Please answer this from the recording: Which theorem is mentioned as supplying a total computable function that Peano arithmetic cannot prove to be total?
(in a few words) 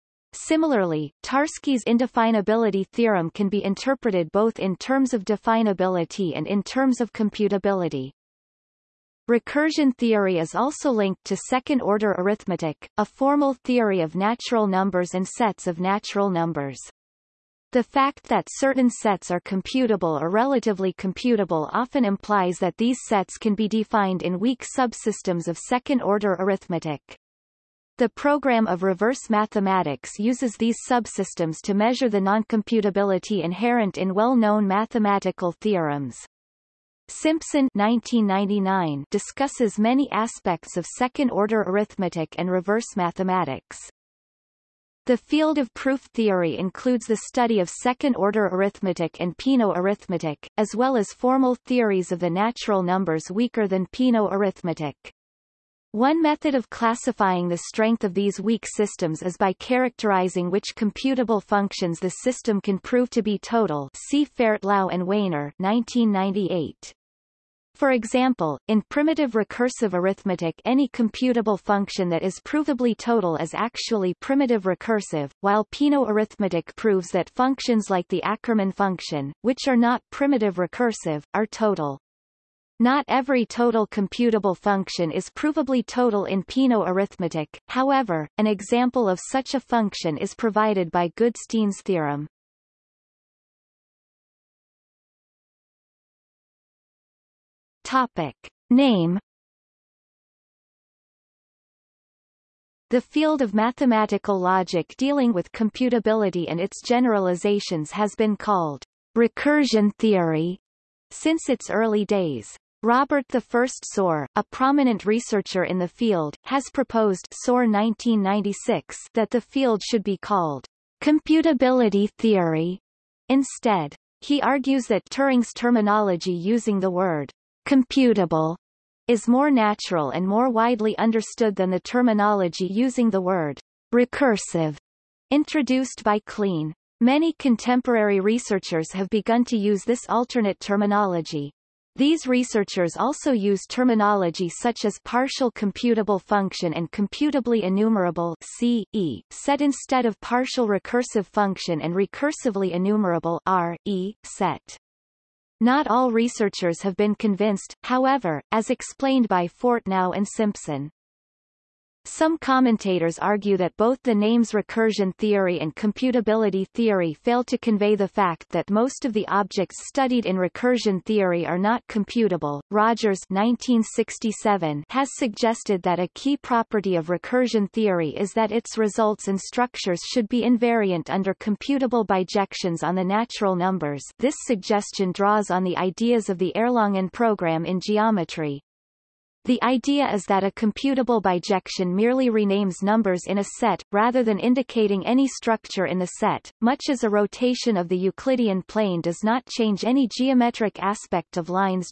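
Goodstein's theorem.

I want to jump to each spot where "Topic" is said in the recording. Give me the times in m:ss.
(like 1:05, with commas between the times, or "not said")
1:37.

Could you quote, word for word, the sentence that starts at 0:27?
The program of reverse mathematics uses these subsystems to measure the noncomputability inherent in well-known mathematical theorems.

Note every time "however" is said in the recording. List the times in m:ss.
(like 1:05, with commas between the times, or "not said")
1:27, 2:37.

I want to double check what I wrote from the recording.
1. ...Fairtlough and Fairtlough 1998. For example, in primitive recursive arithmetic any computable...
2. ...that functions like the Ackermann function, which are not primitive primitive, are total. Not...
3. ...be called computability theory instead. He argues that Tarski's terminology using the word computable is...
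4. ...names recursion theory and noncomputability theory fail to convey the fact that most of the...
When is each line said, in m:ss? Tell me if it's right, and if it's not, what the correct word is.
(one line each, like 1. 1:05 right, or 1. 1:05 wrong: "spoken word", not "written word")
1. 1:04 wrong: "Wainer", not "Fairtlough"
2. 1:17 wrong: "recursive", not "primitive"
3. 2:00 wrong: "Turing", not "Tarski"
4. 2:44 wrong: "computability", not "noncomputability".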